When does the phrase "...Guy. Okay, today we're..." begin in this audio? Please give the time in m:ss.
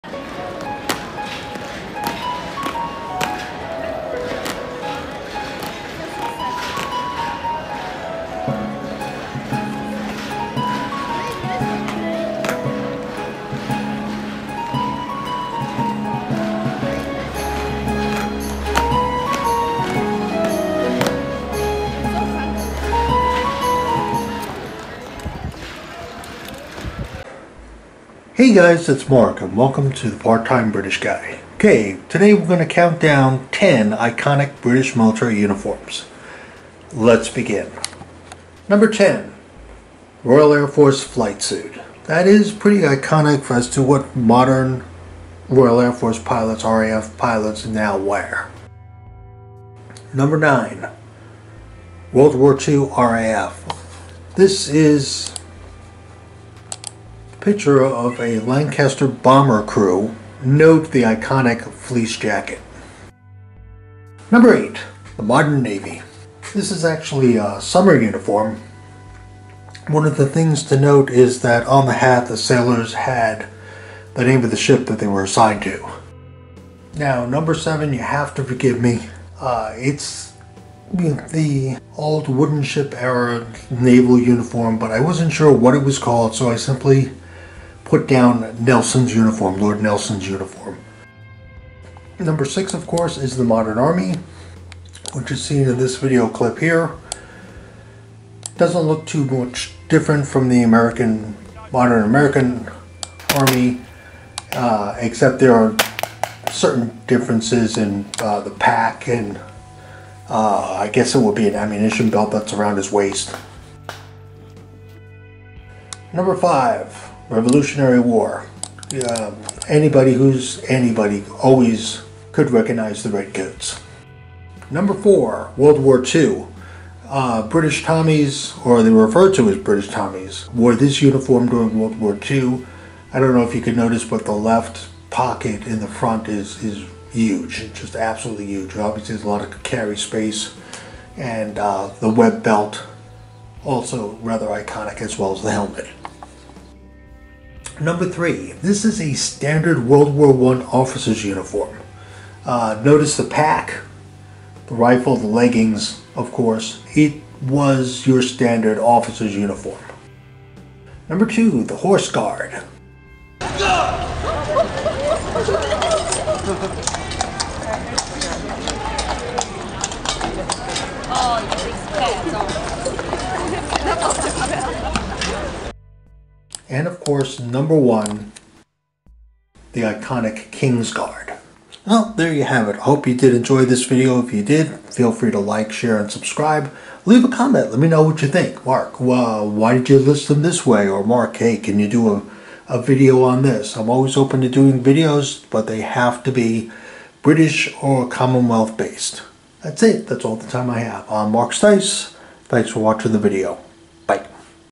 0:30.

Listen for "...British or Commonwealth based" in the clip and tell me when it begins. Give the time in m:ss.
3:17.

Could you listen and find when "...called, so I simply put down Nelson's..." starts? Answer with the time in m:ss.
1:25.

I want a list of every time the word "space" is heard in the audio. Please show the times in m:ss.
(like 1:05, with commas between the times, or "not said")
2:19.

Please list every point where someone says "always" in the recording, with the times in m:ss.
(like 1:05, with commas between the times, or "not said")
2:01, 3:13.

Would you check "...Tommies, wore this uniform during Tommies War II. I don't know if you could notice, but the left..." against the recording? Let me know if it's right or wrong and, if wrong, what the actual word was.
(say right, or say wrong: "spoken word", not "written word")
wrong: "World", not "Tommies".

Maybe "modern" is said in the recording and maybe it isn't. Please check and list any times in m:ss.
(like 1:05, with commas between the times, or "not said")
0:44, 1:05, 1:33, 1:41.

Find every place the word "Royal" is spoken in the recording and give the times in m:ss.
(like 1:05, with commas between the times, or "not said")
0:40, 0:45.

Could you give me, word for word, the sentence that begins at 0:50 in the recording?
Number 9, World War II RAF.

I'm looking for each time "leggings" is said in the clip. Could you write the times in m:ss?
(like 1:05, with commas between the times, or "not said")
2:35.